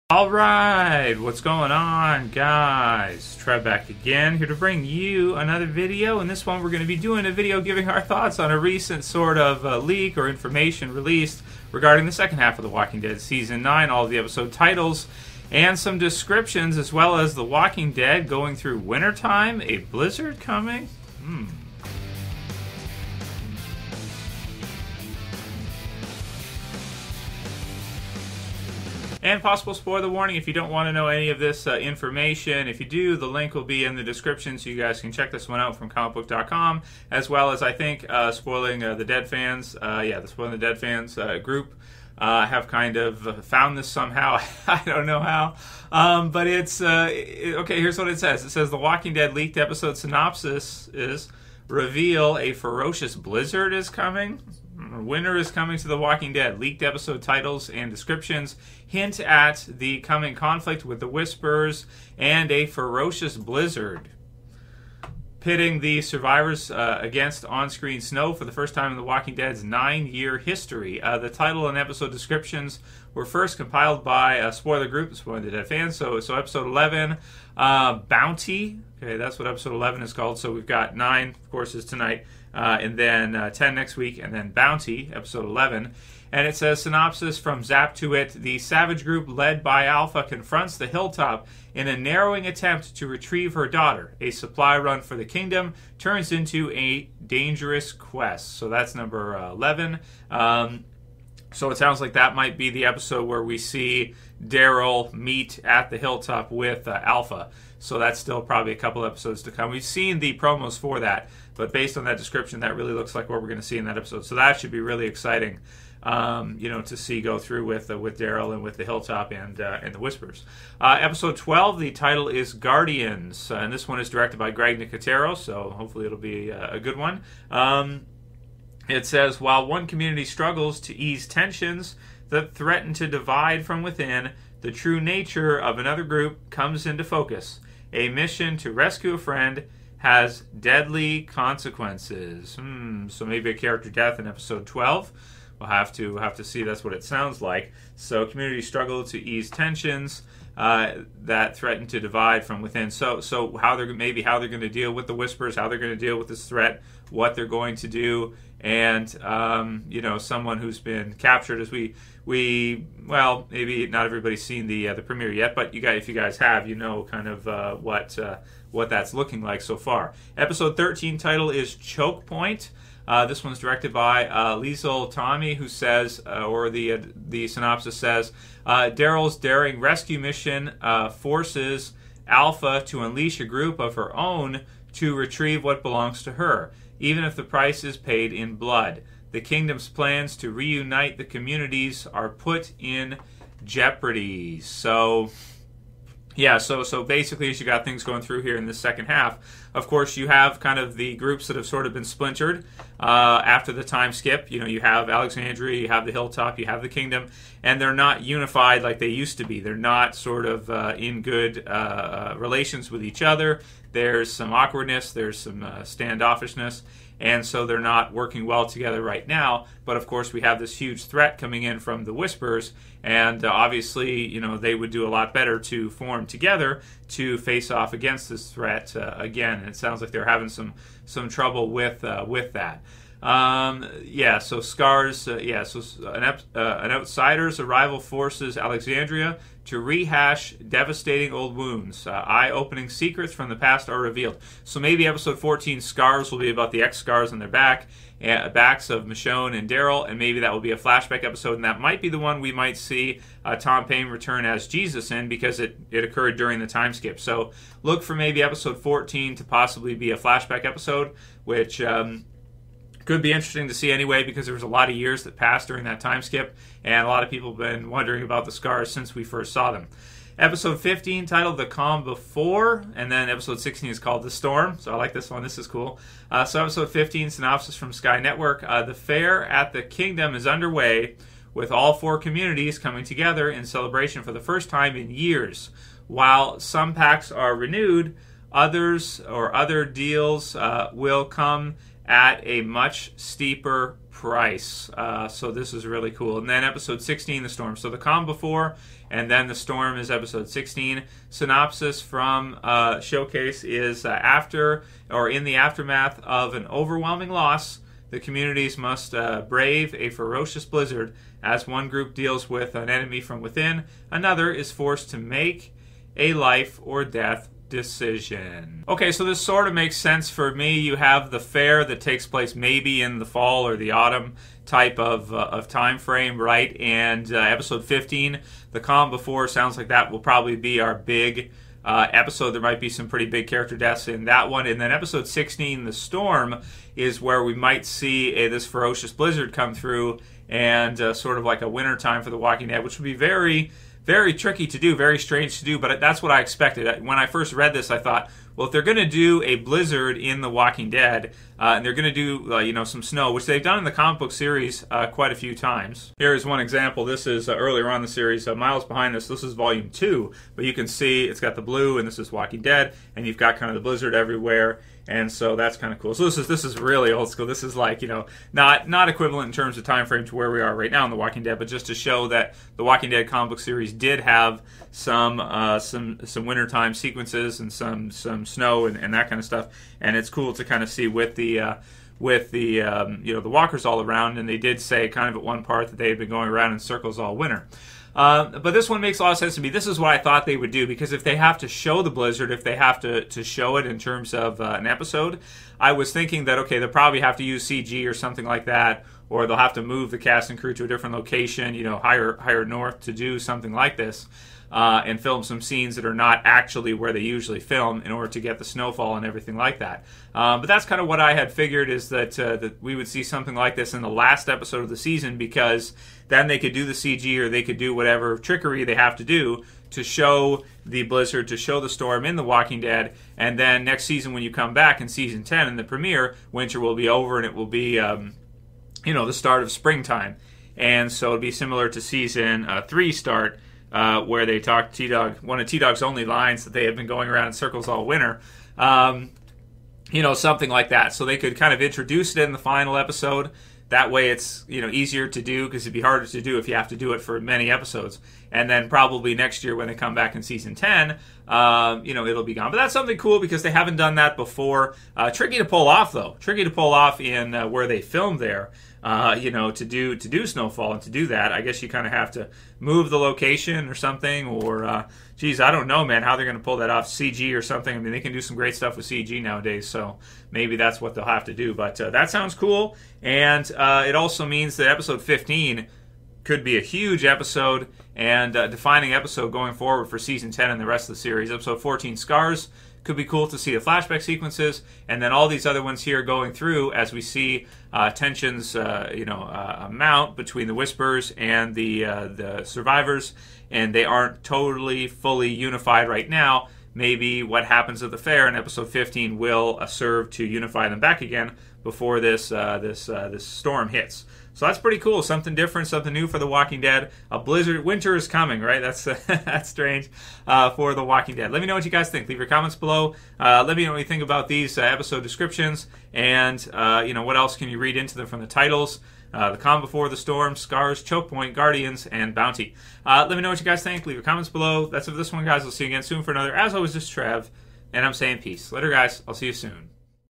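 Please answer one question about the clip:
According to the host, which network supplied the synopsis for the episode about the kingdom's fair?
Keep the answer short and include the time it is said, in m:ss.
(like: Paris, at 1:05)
Sky Network, at 4:37.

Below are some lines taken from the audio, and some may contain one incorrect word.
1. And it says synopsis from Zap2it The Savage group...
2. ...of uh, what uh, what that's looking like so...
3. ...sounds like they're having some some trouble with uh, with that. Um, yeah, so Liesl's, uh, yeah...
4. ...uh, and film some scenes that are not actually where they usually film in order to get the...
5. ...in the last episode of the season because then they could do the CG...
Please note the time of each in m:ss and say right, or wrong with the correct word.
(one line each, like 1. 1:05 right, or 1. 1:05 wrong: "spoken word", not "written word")
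1. 1:26 right
2. 2:47 right
3. 3:49 wrong: "Scar", not "Liesl"
4. 6:44 right
5. 6:53 right.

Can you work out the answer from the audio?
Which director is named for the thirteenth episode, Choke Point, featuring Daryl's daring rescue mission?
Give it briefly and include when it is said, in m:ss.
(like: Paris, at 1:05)
Liesl Tommy, at 2:54.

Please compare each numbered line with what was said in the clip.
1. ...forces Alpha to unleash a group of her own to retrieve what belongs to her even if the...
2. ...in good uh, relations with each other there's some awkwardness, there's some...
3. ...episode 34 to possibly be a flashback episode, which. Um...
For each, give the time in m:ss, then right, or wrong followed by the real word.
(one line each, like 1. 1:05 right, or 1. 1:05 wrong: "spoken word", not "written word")
1. 3:01 right
2. 3:30 right
3. 4:18 wrong: "14", not "34".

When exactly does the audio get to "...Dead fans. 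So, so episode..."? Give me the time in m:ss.
1:15.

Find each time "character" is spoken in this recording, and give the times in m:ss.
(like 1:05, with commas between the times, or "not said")
2:23, 5:33.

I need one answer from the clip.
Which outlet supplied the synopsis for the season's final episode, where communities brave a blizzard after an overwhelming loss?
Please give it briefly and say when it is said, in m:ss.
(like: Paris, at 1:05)
Showcase, at 5:02.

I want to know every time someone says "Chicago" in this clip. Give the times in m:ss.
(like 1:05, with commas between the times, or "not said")
not said.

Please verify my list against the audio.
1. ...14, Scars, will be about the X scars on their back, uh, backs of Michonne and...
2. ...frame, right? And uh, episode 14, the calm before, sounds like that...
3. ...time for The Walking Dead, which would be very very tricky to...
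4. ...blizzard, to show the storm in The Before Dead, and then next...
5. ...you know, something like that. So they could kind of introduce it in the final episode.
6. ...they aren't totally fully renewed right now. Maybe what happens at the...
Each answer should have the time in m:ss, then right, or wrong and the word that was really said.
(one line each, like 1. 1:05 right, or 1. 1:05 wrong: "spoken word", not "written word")
1. 4:05 right
2. 5:25 wrong: "15", not "14"
3. 5:41 right
4. 7:01 wrong: "Walking", not "Before"
5. 7:20 right
6. 8:13 wrong: "unified", not "renewed".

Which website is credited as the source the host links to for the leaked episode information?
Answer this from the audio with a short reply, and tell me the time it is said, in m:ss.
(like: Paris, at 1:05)
comicbook.com, at 0:35.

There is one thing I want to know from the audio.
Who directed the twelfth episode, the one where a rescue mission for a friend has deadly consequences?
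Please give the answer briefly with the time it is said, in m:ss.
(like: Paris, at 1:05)
Greg Nicotero, at 2:04.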